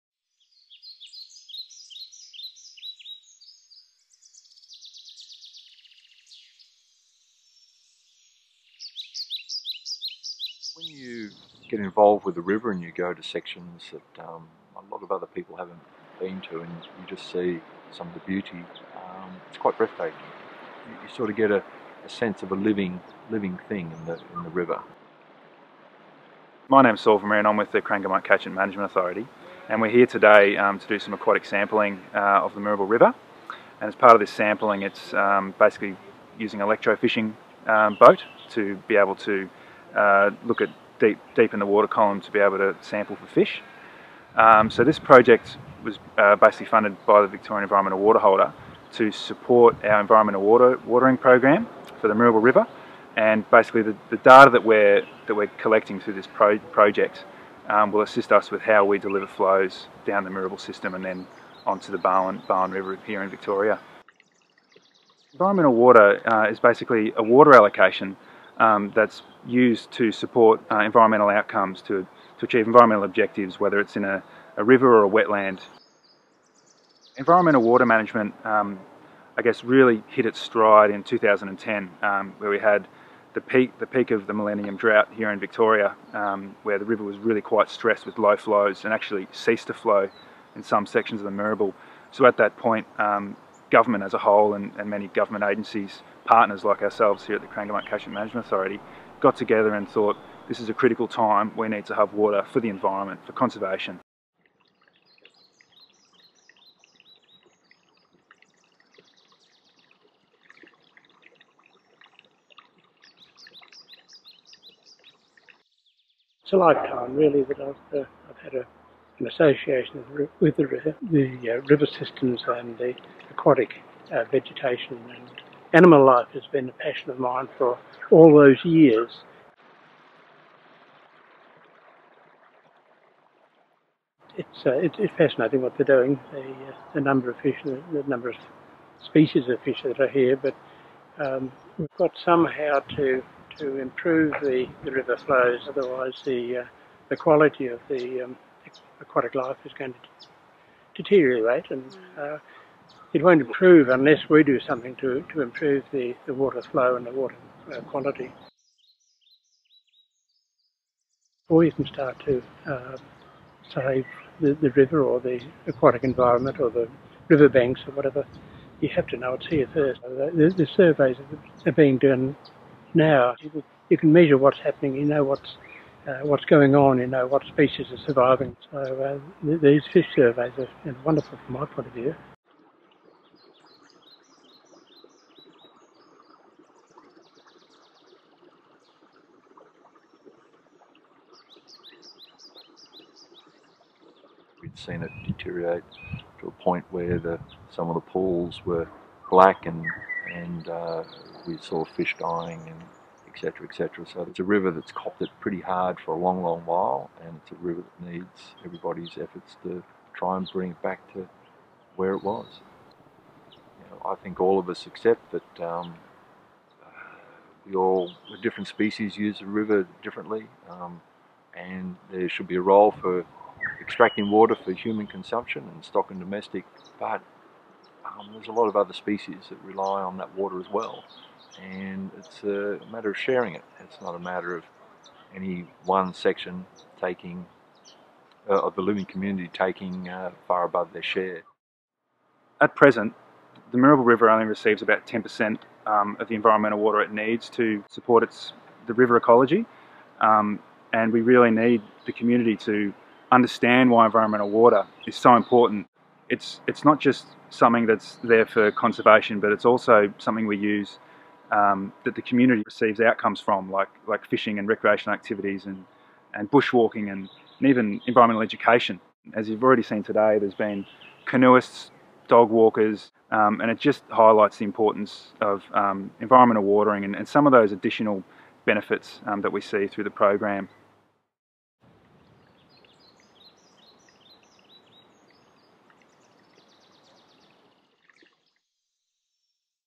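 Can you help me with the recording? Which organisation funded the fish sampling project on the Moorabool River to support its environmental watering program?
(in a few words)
Victorian Environmental Water Holder.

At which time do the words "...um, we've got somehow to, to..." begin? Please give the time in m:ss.
2:21.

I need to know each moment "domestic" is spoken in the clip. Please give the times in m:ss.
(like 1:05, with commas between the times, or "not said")
3:46.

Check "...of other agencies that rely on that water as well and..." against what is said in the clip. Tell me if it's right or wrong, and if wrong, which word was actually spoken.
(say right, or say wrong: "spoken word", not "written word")
wrong: "species", not "agencies".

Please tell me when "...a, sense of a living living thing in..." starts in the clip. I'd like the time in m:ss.
0:22.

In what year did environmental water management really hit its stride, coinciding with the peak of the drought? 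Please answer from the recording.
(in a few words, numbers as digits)
2010.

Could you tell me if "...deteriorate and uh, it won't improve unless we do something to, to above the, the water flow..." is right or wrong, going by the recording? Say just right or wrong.
wrong.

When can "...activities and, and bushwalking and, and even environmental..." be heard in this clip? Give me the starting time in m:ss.
4:25.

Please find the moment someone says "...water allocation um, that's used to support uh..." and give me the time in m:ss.
1:07.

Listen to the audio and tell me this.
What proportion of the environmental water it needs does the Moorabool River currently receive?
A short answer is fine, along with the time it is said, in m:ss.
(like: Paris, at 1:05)
10%, at 4:05.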